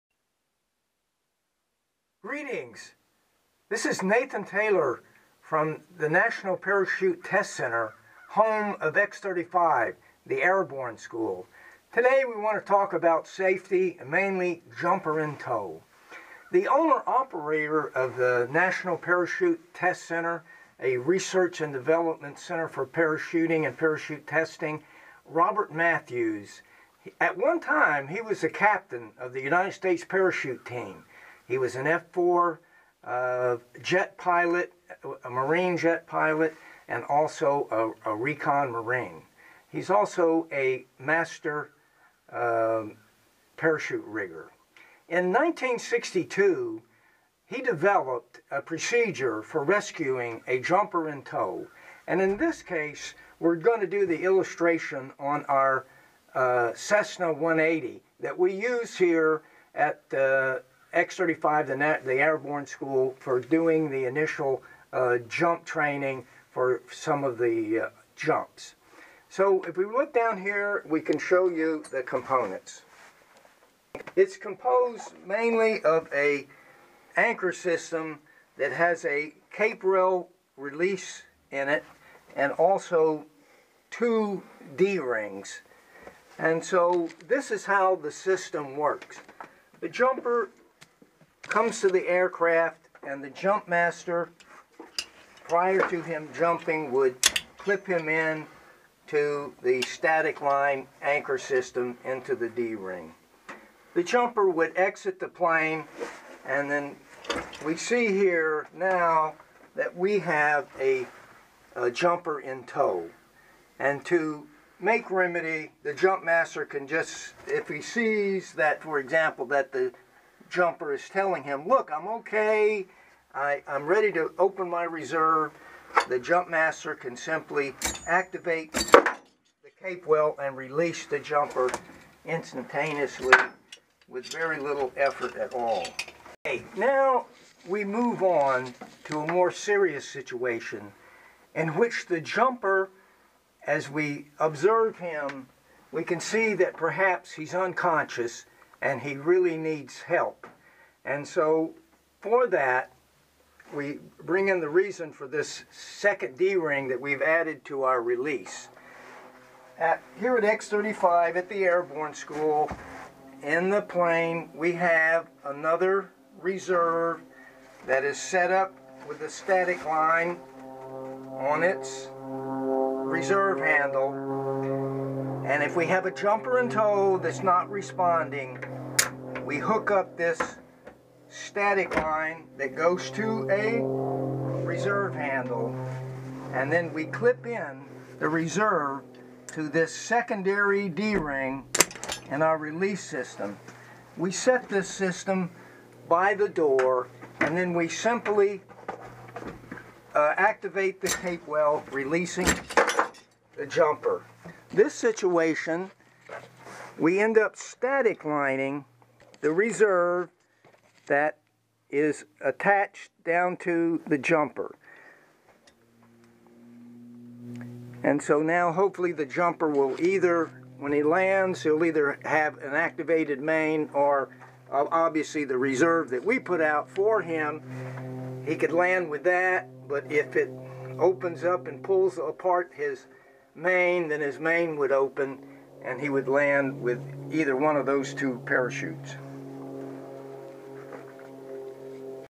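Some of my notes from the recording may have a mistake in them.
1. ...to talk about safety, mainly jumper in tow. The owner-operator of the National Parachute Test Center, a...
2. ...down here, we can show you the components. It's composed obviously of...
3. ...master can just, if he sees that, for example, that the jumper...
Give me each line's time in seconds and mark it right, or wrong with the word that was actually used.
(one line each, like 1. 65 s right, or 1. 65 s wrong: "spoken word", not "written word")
1. 12 s right
2. 70 s wrong: "mainly", not "obviously"
3. 116 s right.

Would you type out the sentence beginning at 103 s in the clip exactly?
The jumper would exit the plane and then we see here now that we have a, a jumper in tow.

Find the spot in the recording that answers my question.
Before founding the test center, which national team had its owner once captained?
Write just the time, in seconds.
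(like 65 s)
29 s.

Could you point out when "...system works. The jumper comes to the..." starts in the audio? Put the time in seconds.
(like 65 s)
88 s.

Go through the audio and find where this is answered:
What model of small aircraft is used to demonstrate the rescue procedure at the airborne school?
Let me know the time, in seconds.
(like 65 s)
56 s.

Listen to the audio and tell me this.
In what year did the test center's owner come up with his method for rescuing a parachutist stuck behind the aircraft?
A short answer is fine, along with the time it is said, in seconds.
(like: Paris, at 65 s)
1962, at 45 s.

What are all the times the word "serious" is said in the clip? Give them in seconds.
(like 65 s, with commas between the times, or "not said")
139 s.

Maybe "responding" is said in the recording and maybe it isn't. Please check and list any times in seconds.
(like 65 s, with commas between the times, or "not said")
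177 s.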